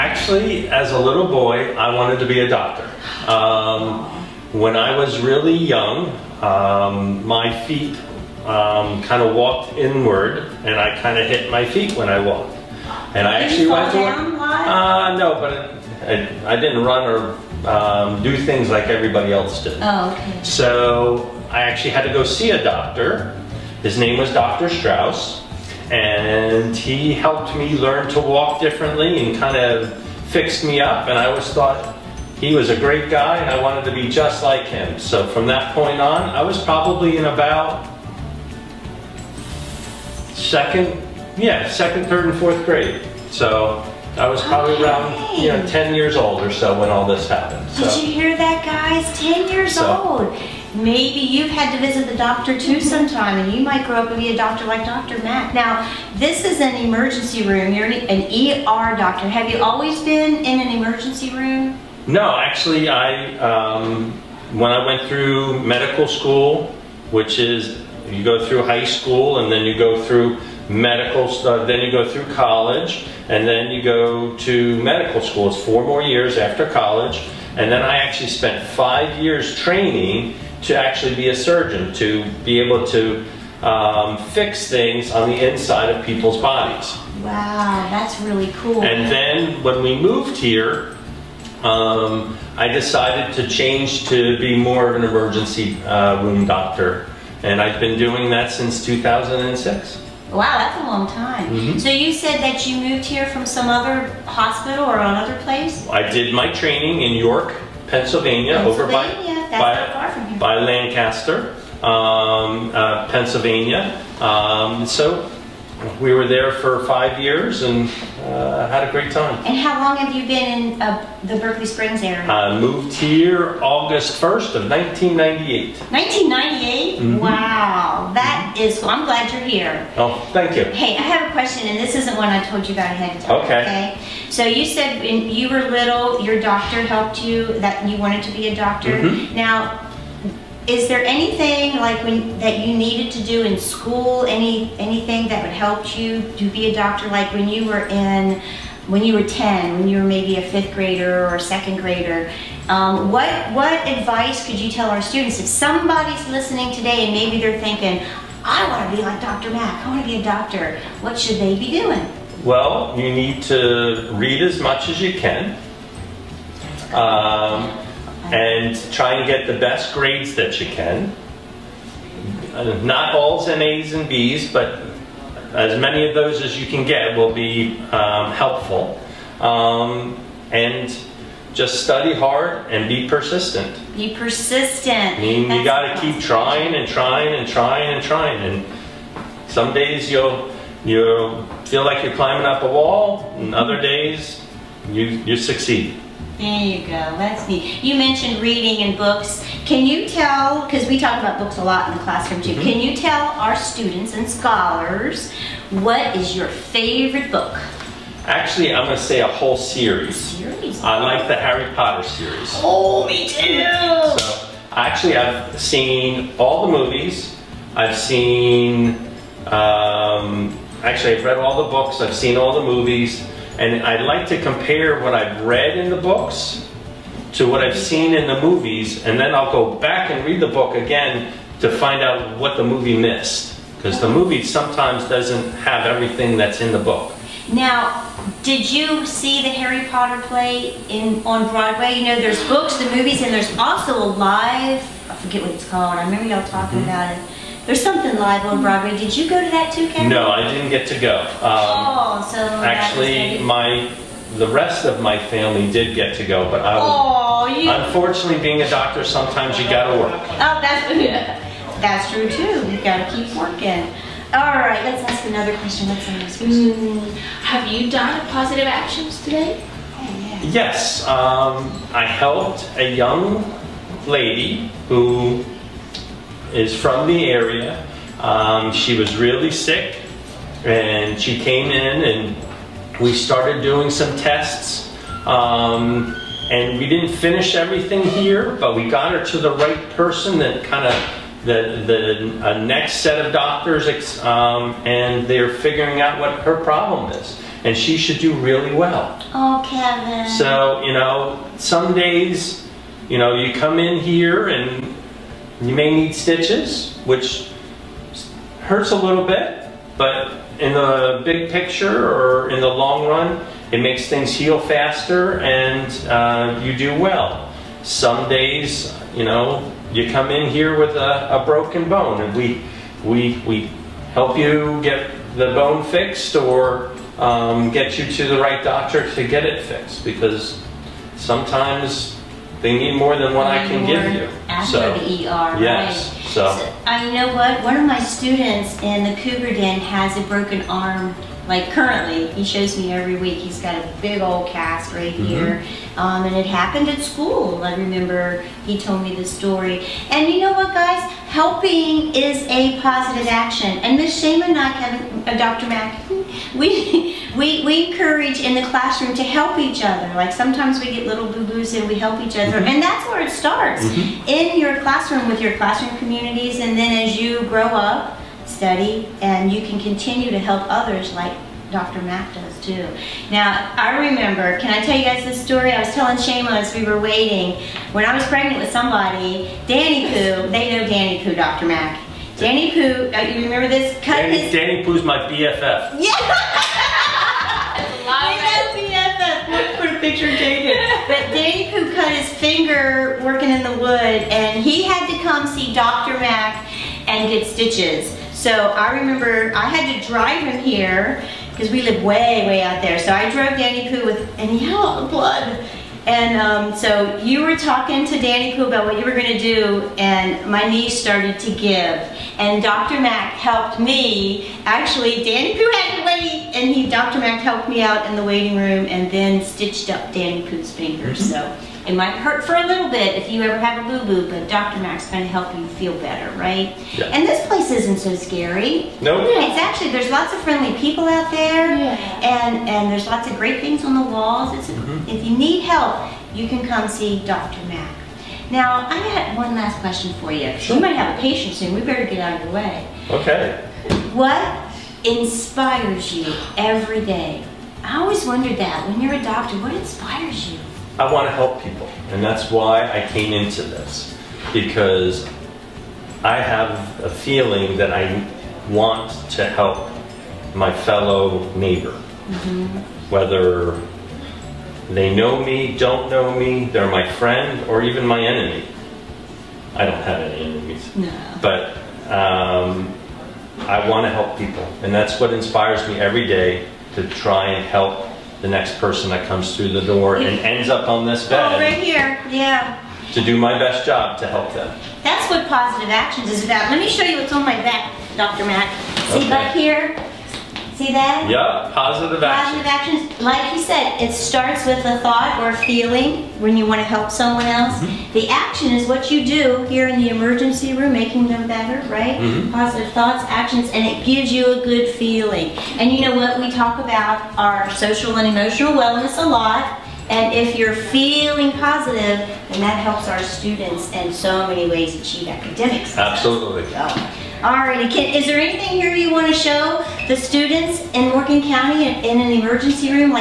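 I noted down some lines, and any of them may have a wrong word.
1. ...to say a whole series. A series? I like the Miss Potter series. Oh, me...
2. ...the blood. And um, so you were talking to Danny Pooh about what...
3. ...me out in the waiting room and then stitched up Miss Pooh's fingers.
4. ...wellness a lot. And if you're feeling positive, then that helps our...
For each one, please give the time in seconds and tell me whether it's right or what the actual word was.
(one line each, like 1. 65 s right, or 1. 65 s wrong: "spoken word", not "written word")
1. 208 s wrong: "Harry", not "Miss"
2. 405 s right
3. 417 s wrong: "Danny", not "Miss"
4. 508 s right.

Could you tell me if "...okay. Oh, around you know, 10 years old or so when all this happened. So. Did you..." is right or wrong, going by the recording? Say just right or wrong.
right.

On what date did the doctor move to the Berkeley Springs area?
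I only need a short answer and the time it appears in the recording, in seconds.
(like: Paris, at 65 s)
August 1st, 1998, at 123 s.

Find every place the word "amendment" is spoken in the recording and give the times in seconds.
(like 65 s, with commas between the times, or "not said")
not said.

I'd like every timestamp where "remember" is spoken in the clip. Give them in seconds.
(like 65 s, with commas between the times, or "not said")
246 s, 347 s, 374 s, 383 s, 398 s.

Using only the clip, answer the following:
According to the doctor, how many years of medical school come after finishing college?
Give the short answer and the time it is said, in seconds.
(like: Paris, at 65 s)
4, at 75 s.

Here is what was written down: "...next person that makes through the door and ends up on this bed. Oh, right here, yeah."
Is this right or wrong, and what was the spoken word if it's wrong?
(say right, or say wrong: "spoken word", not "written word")
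wrong: "comes", not "makes".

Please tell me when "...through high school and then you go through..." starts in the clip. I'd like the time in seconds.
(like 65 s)
68 s.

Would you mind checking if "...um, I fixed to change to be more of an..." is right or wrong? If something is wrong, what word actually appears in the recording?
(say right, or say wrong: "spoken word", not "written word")
wrong: "decided", not "fixed".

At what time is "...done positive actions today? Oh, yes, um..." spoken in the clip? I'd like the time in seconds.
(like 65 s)
267 s.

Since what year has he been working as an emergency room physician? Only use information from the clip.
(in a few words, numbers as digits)
2006.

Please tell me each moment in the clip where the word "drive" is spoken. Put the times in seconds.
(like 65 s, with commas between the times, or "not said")
400 s.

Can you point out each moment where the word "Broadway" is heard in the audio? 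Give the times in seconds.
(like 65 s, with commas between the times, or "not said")
241 s, 248 s.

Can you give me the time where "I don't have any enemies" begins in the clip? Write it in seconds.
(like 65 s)
469 s.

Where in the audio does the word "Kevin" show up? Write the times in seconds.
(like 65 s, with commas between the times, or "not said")
249 s, 299 s.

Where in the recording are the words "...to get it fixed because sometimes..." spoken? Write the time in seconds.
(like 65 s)
329 s.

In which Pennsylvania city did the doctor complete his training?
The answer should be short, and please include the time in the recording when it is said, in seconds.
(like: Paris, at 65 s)
York, at 107 s.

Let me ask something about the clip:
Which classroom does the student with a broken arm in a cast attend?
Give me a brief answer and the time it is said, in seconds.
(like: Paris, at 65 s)
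Cougar Den, at 339 s.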